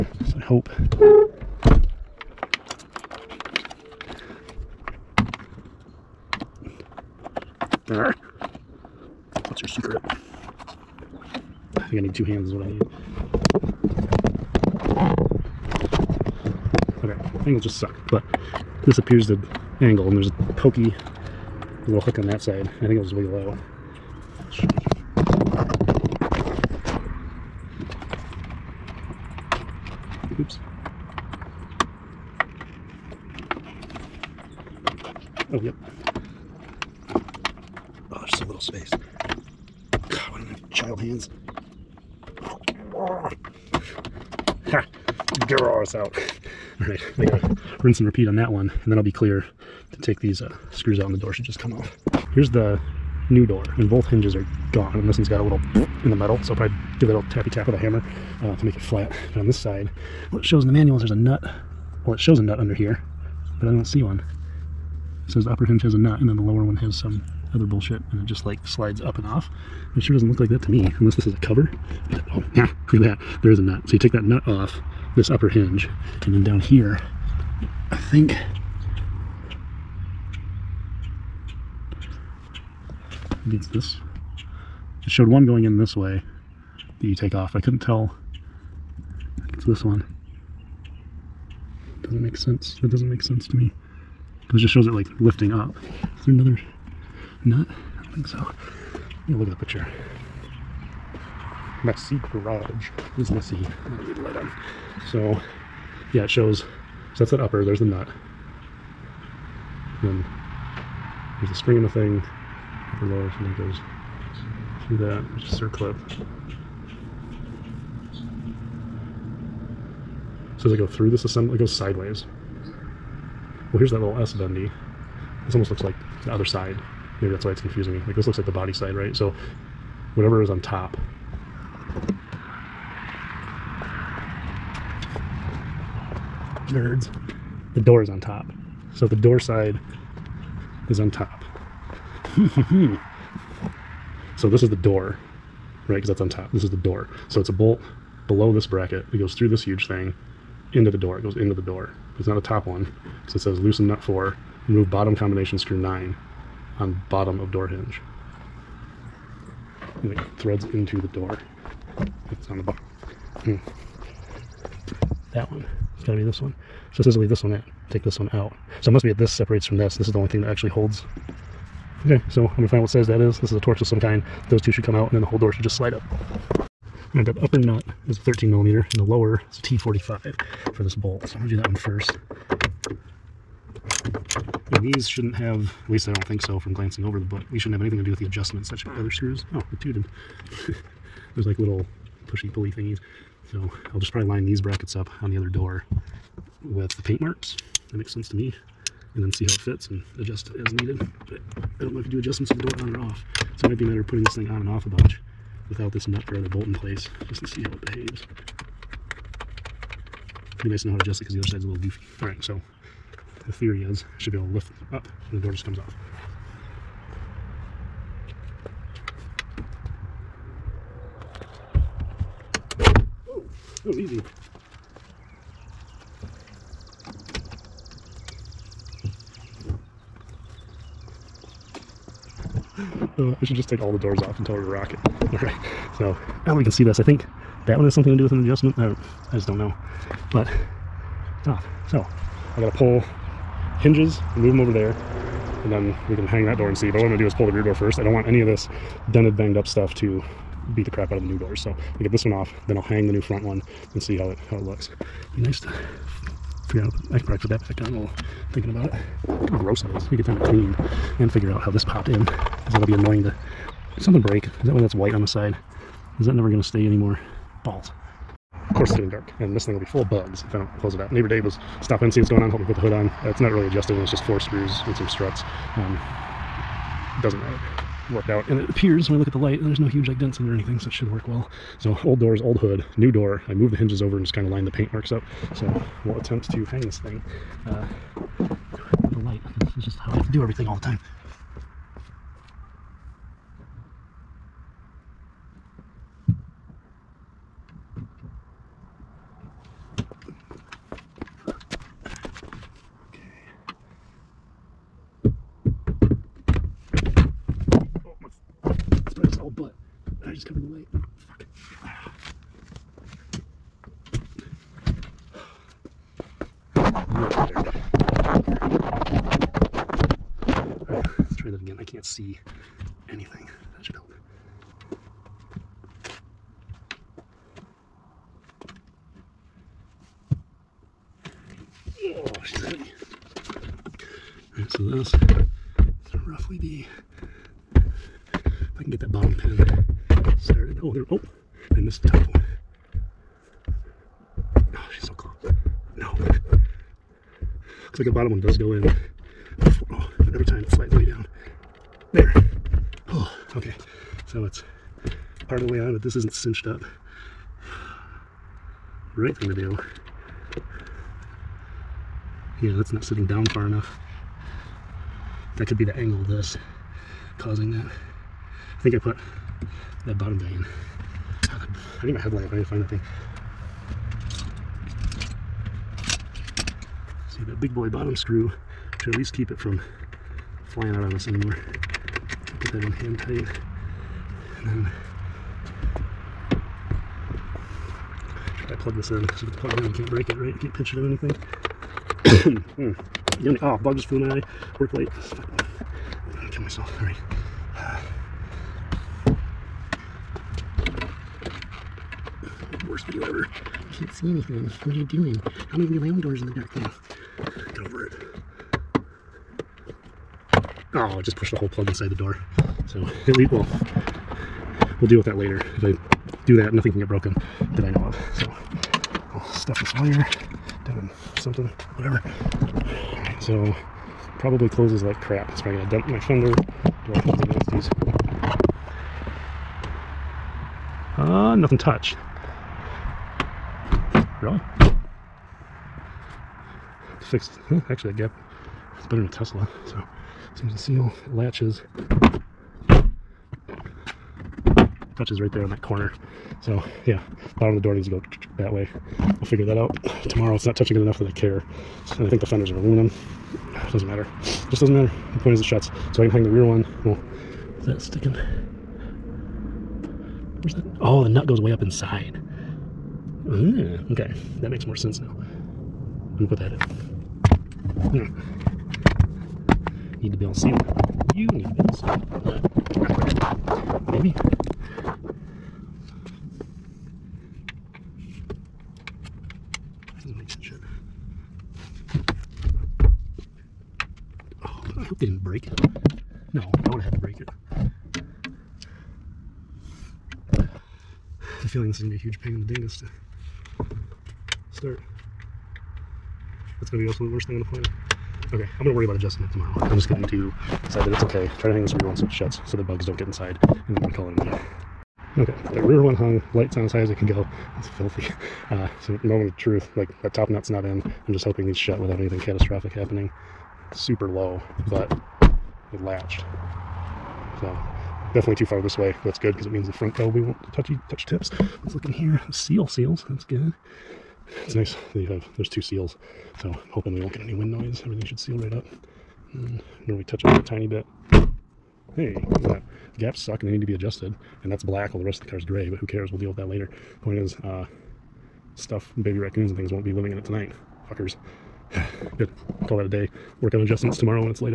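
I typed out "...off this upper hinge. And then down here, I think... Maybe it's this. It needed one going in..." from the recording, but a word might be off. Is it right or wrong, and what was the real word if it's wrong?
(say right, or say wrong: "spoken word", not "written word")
wrong: "showed", not "needed".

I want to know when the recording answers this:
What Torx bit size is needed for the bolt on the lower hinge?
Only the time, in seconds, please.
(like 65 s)
179 s.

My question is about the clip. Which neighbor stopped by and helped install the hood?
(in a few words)
Dave.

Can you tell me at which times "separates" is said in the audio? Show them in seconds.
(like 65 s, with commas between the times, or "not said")
169 s.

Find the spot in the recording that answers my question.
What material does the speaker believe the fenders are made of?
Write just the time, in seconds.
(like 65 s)
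452 s.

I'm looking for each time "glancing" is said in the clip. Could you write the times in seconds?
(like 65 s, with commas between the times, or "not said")
186 s.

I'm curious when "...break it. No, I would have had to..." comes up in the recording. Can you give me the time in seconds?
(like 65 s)
485 s.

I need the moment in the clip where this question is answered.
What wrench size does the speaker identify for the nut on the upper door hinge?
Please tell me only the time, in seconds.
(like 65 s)
178 s.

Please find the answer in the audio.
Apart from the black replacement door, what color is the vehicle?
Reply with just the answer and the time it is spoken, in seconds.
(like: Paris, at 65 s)
gray, at 535 s.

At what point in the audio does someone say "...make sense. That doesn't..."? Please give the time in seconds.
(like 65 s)
92 s.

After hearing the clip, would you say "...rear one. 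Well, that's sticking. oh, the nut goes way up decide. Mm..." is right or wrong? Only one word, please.
wrong.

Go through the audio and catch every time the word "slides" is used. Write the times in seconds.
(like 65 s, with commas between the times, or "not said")
68 s, 175 s, 350 s.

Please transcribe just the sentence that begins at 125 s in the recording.
This almost looks like the other side.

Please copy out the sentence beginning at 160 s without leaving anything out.
And it threads into the door.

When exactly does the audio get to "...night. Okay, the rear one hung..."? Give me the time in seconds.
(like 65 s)
504 s.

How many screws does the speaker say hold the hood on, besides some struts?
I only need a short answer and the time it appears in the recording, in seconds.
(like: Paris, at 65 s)
4, at 274 s.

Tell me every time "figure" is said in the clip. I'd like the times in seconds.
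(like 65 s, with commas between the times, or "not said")
256 s, 261 s, 449 s.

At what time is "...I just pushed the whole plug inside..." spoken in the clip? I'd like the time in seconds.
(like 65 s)
411 s.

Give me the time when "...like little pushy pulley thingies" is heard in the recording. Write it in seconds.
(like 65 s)
191 s.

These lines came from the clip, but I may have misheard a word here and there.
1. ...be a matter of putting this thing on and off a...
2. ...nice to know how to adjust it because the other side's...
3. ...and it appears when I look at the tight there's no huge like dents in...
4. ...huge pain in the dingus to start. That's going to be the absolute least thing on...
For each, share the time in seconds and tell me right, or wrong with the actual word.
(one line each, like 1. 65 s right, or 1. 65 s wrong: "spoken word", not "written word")
1. 203 s right
2. 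210 s right
3. 278 s wrong: "light", not "tight"
4. 492 s wrong: "worst", not "least".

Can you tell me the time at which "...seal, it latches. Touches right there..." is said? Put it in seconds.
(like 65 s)
440 s.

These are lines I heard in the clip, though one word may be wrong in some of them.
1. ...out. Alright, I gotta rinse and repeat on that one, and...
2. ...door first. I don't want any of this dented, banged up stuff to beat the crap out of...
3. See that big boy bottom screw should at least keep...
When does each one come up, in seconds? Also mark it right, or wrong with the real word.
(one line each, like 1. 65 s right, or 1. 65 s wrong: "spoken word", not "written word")
1. 45 s right
2. 247 s right
3. 377 s right.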